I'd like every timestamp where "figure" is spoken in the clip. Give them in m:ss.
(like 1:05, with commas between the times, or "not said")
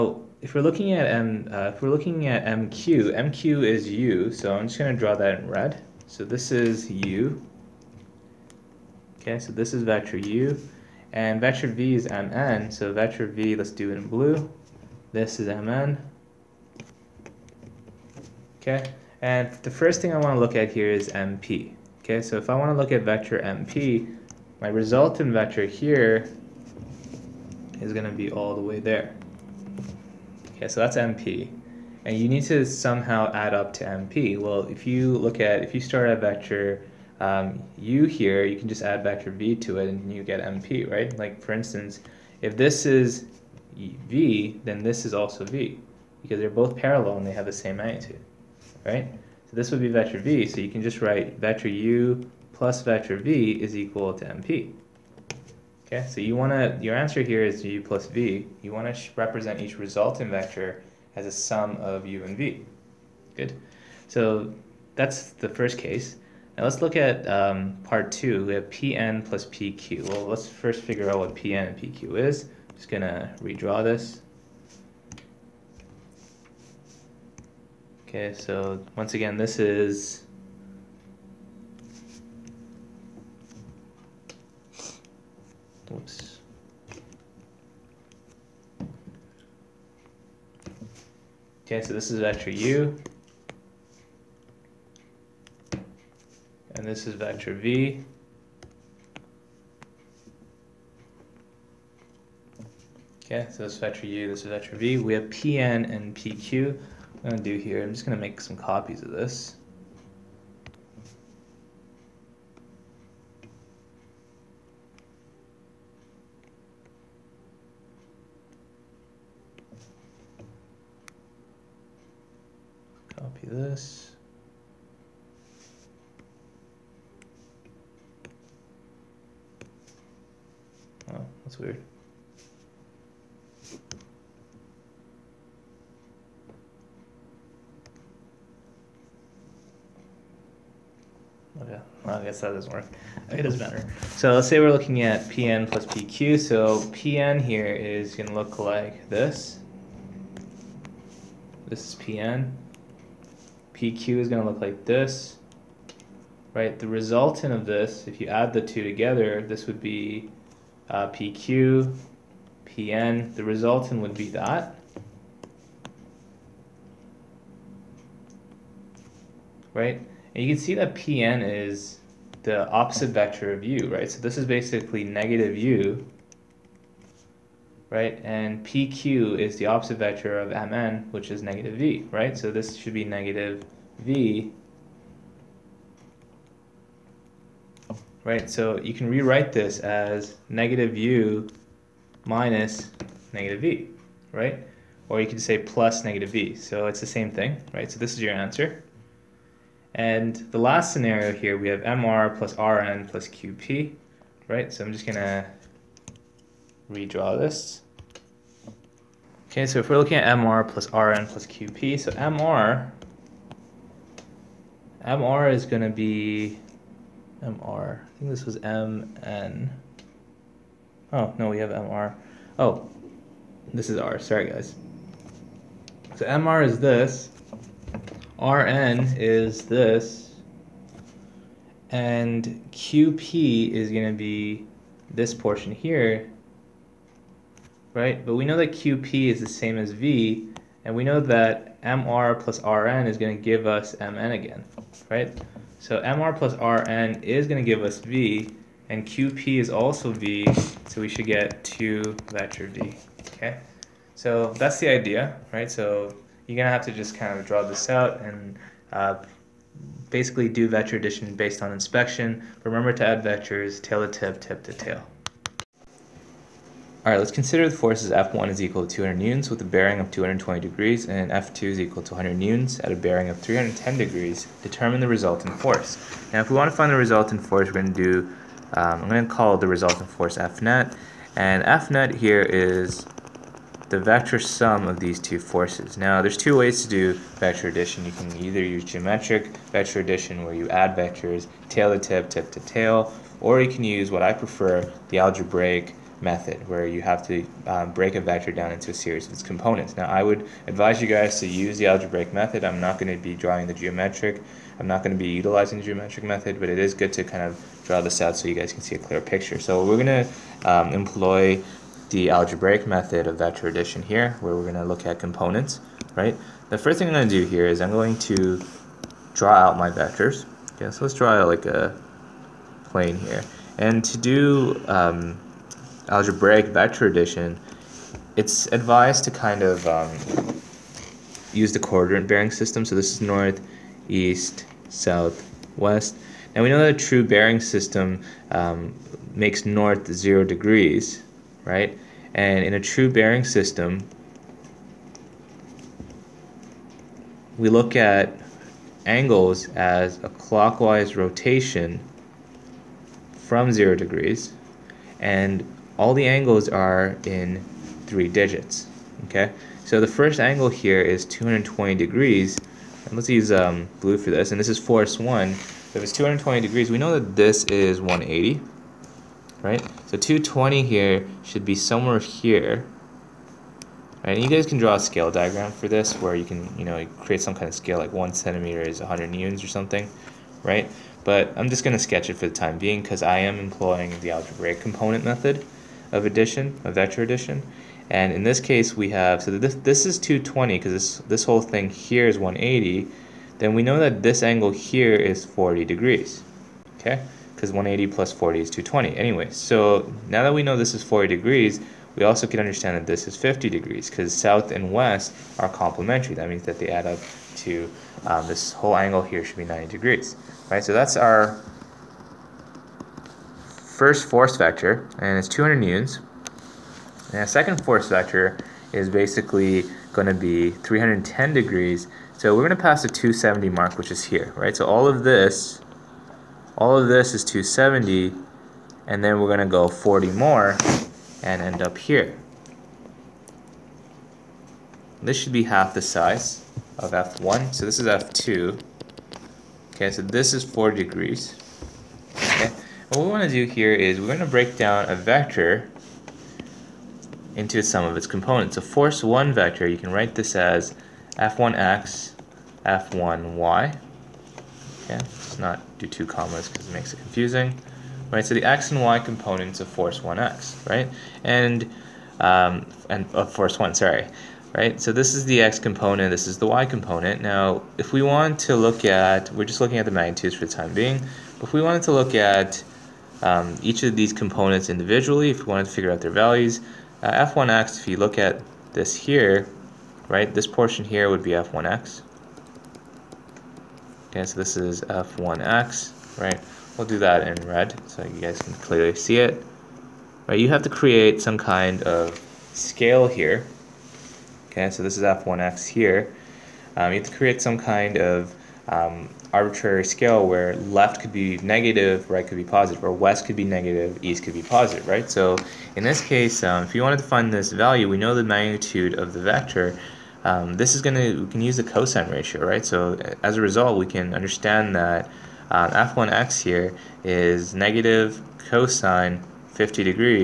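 1:10, 7:55.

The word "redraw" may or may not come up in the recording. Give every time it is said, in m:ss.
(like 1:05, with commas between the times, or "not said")
1:13, 3:26.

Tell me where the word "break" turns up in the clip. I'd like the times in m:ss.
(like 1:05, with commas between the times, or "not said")
4:57, 7:24.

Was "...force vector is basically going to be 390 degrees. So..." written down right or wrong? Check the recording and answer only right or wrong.
wrong.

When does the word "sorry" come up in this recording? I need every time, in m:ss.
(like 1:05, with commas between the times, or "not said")
3:44, 7:43.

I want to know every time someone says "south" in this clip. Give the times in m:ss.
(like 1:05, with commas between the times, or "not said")
5:34, 6:44.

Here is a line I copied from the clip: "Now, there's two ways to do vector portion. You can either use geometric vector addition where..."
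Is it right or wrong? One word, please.
wrong.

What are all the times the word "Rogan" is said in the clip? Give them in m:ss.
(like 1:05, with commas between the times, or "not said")
not said.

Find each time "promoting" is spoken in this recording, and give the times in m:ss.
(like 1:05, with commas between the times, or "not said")
not said.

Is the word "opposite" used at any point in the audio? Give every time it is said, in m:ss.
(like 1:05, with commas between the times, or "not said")
2:52, 2:59.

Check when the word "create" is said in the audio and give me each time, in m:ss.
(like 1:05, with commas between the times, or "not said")
6:17, 8:10, 8:17.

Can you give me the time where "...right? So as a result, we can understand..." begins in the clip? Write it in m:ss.
8:32.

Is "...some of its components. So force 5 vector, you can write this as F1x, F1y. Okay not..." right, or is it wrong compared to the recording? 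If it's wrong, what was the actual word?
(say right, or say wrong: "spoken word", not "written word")
wrong: "1", not "5".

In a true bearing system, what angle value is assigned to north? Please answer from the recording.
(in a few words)
0 degrees.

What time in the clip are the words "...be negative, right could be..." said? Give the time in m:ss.
8:21.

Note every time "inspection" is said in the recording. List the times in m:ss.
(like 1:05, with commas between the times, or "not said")
4:21.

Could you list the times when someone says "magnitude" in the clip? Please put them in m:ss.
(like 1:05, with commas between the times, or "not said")
0:47, 7:50, 8:28.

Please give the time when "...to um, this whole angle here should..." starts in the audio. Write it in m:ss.
6:47.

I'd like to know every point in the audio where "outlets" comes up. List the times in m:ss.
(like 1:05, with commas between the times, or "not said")
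not said.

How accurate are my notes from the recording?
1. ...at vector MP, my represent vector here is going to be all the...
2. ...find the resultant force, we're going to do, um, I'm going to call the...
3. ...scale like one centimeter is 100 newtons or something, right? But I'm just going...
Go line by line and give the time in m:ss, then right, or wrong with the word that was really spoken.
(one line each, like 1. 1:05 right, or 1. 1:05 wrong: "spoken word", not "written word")
1. 0:22 wrong: "resultant", not "represent"
2. 4:36 right
3. 6:17 right.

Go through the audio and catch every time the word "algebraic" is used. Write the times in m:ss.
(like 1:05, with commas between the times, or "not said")
4:55, 5:01, 5:12, 5:26, 6:24.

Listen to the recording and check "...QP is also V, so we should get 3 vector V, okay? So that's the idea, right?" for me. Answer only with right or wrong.
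wrong.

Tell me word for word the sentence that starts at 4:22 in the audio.
Remember to add vectors tail to tip, tip to tail.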